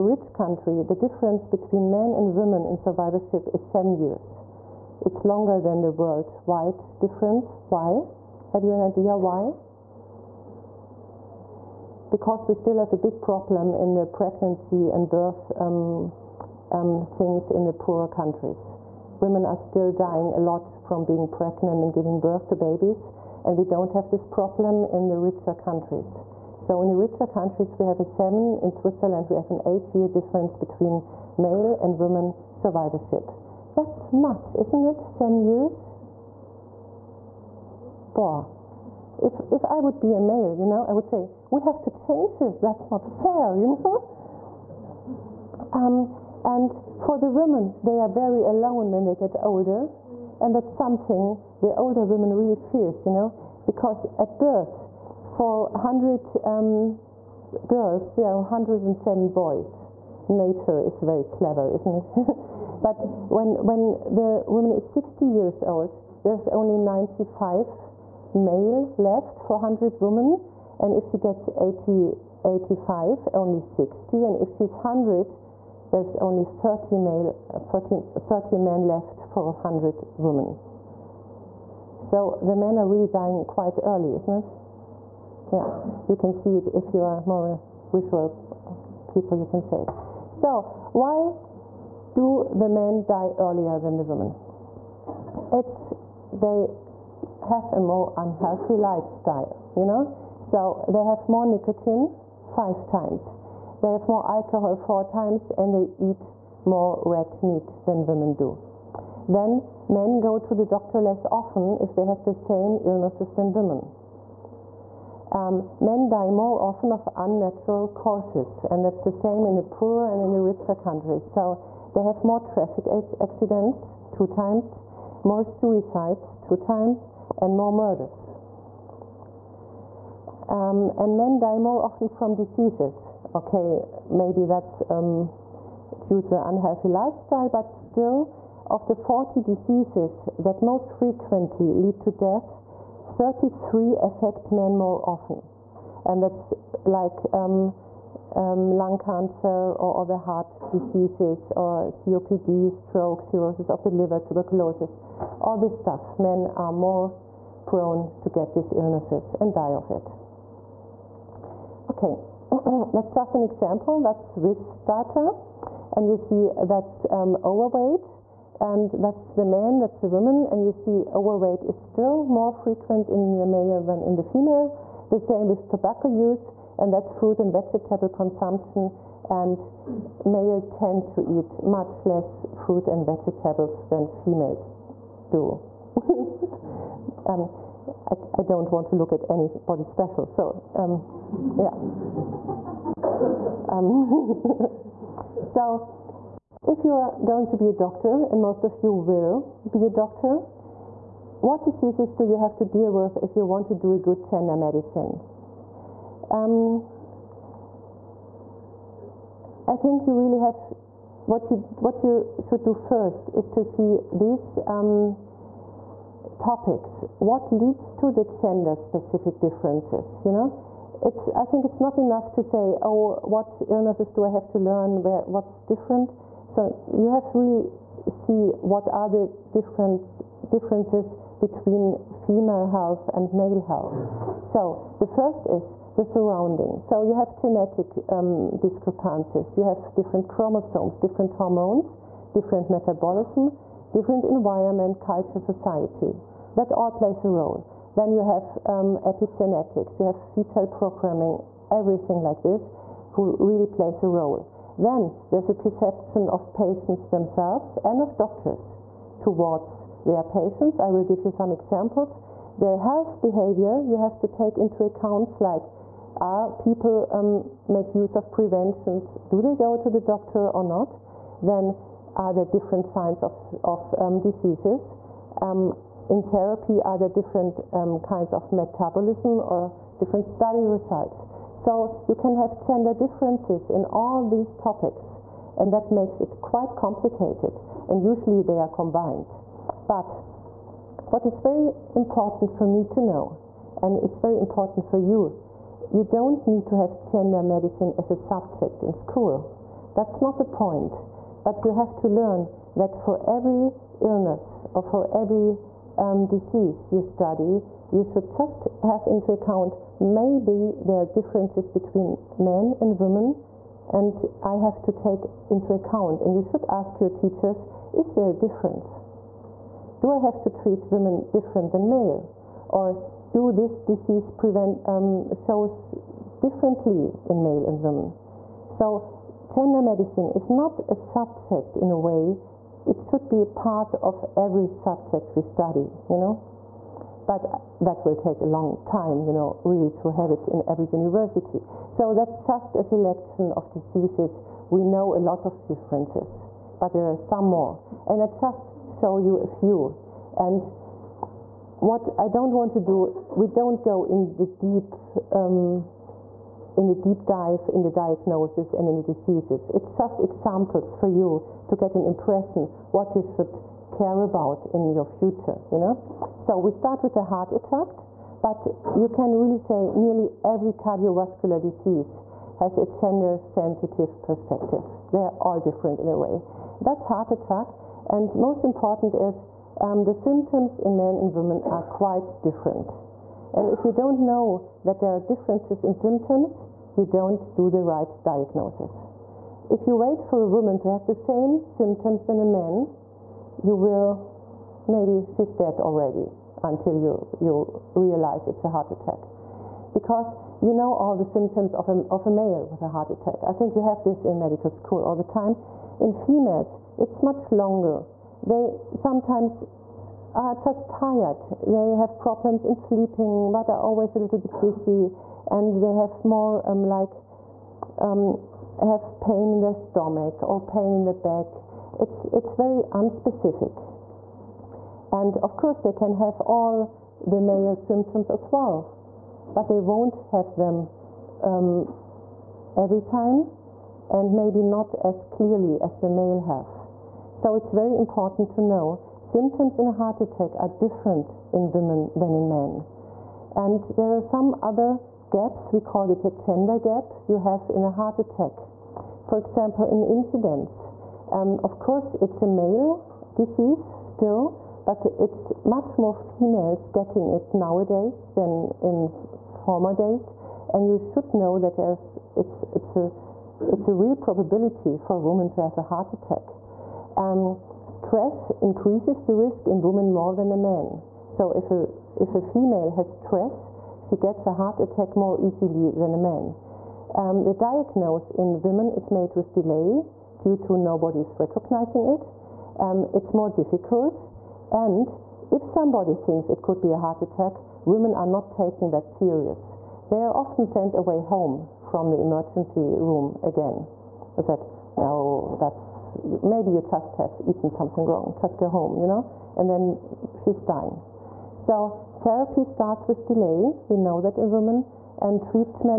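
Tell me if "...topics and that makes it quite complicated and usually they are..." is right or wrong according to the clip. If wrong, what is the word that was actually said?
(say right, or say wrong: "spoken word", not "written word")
right.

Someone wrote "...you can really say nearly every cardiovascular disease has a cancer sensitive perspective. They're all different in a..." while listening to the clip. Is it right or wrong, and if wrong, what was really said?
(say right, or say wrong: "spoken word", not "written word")
wrong: "gender", not "cancer".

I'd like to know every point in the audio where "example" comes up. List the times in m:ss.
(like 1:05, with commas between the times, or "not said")
2:43, 4:21, 6:00, 7:29.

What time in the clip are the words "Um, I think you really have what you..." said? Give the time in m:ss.
3:26.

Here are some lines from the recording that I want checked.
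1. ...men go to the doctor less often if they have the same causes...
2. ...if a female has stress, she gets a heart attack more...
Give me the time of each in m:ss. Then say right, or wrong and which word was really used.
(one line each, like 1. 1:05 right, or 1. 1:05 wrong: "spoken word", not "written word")
1. 1:49 wrong: "illnesses", not "causes"
2. 7:52 right.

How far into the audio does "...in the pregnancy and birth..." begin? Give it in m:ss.
0:13.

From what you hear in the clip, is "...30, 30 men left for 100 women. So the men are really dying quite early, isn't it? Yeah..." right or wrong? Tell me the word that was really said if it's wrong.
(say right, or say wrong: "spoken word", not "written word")
right.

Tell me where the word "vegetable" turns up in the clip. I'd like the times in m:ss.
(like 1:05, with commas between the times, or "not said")
2:57, 3:03.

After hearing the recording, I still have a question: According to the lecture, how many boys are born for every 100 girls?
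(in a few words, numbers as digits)
107.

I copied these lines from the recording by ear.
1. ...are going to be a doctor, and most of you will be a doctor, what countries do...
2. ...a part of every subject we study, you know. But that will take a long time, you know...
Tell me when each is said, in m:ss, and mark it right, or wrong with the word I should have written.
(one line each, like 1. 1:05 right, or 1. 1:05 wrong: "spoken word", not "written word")
1. 3:16 wrong: "diseases", not "countries"
2. 5:33 right.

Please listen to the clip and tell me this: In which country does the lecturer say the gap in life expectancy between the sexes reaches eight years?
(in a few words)
Switzerland.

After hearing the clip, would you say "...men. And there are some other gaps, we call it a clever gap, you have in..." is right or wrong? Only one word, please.
wrong.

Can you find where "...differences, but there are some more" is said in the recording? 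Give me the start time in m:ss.
5:45.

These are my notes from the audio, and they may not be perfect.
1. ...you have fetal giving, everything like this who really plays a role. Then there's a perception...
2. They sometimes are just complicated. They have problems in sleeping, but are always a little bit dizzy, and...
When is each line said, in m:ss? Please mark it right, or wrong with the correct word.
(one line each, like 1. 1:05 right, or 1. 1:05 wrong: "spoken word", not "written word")
1. 4:09 wrong: "programming", not "giving"
2. 6:48 wrong: "tired", not "complicated".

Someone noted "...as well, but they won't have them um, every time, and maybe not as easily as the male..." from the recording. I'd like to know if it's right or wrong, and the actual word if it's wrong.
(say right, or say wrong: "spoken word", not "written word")
wrong: "clearly", not "easily".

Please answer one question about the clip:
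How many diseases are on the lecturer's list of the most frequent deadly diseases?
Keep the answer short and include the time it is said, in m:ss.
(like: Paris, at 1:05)
40, at 2:18.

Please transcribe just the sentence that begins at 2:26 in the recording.
And that's like um, um, lung cancer or other heart diseases or COPD, stroke, cirrhosis of the liver, tuberculosis, all this stuff.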